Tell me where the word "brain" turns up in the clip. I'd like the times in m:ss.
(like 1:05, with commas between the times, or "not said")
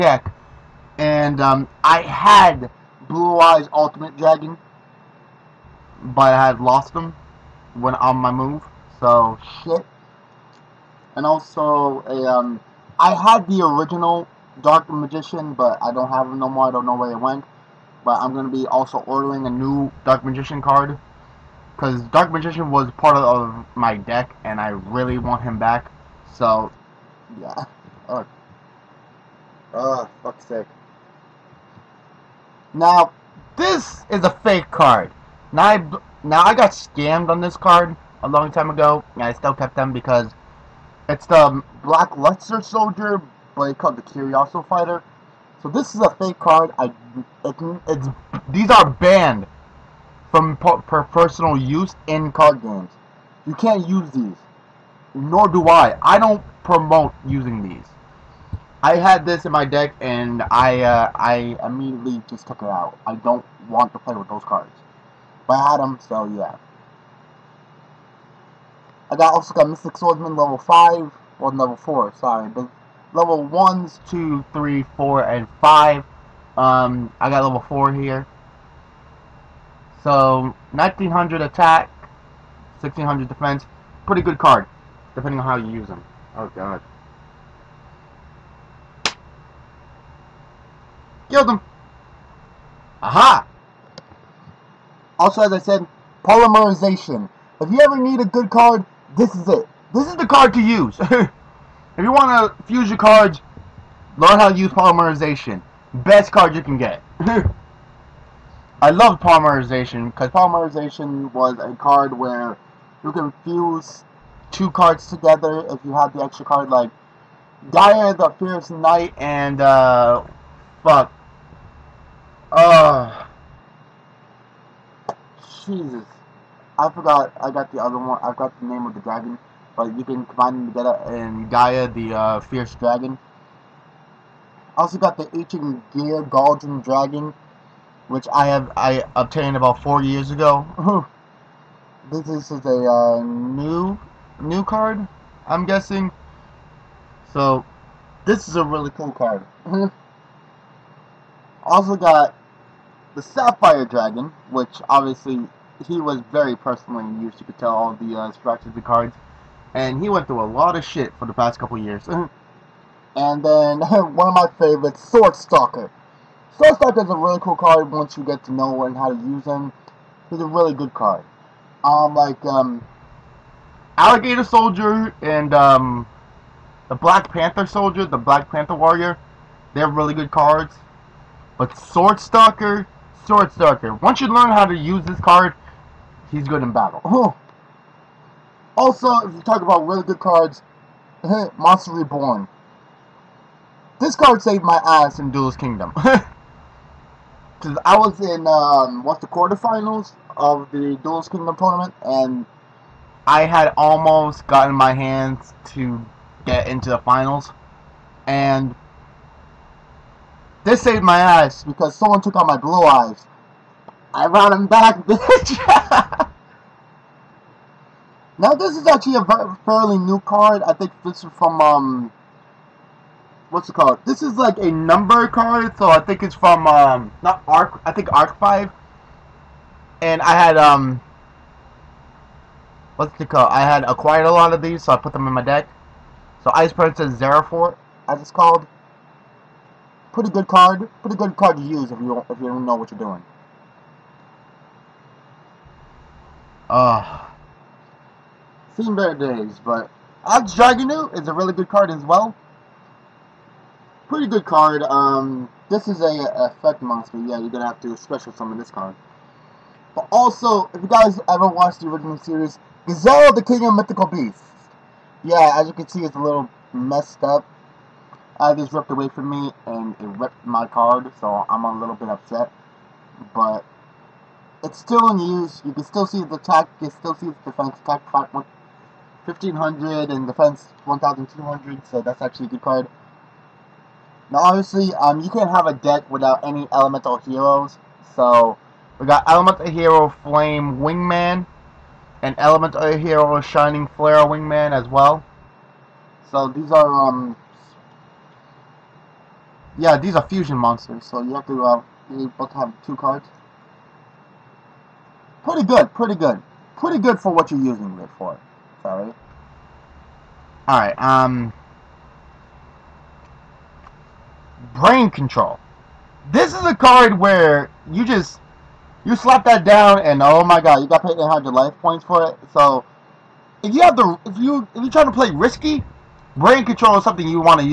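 5:14, 5:26.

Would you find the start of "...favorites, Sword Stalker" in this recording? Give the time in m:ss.
2:44.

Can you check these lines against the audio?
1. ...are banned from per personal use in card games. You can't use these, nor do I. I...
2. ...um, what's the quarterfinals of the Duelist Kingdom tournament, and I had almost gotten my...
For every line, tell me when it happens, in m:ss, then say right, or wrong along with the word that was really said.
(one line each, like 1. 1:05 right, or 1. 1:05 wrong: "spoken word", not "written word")
1. 0:48 right
2. 3:18 right.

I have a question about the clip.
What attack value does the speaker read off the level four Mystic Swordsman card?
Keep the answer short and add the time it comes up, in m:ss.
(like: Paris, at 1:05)
1900, at 1:20.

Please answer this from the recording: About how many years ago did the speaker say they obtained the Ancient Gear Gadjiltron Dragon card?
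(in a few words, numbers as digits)
4.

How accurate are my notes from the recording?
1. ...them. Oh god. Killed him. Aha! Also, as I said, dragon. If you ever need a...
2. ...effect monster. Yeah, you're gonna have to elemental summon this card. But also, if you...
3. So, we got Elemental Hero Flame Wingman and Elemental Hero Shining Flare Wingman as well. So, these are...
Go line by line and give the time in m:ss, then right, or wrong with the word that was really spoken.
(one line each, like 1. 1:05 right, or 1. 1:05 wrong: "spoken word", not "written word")
1. 1:25 wrong: "polymerization", not "dragon"
2. 4:16 wrong: "special", not "elemental"
3. 4:48 right.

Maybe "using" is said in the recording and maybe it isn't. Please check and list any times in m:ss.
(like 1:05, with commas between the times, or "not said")
0:57, 5:07.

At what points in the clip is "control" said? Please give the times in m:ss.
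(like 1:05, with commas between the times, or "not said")
5:15, 5:26.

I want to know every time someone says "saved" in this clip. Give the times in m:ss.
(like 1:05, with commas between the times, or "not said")
3:14, 3:30.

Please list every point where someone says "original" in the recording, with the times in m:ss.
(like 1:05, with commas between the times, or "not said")
0:13, 4:21.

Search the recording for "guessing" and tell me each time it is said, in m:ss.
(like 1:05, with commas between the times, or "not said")
2:25.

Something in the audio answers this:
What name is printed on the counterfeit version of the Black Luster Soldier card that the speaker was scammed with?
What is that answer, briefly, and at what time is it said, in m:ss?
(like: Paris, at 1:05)
Curioso Fighter, at 0:44.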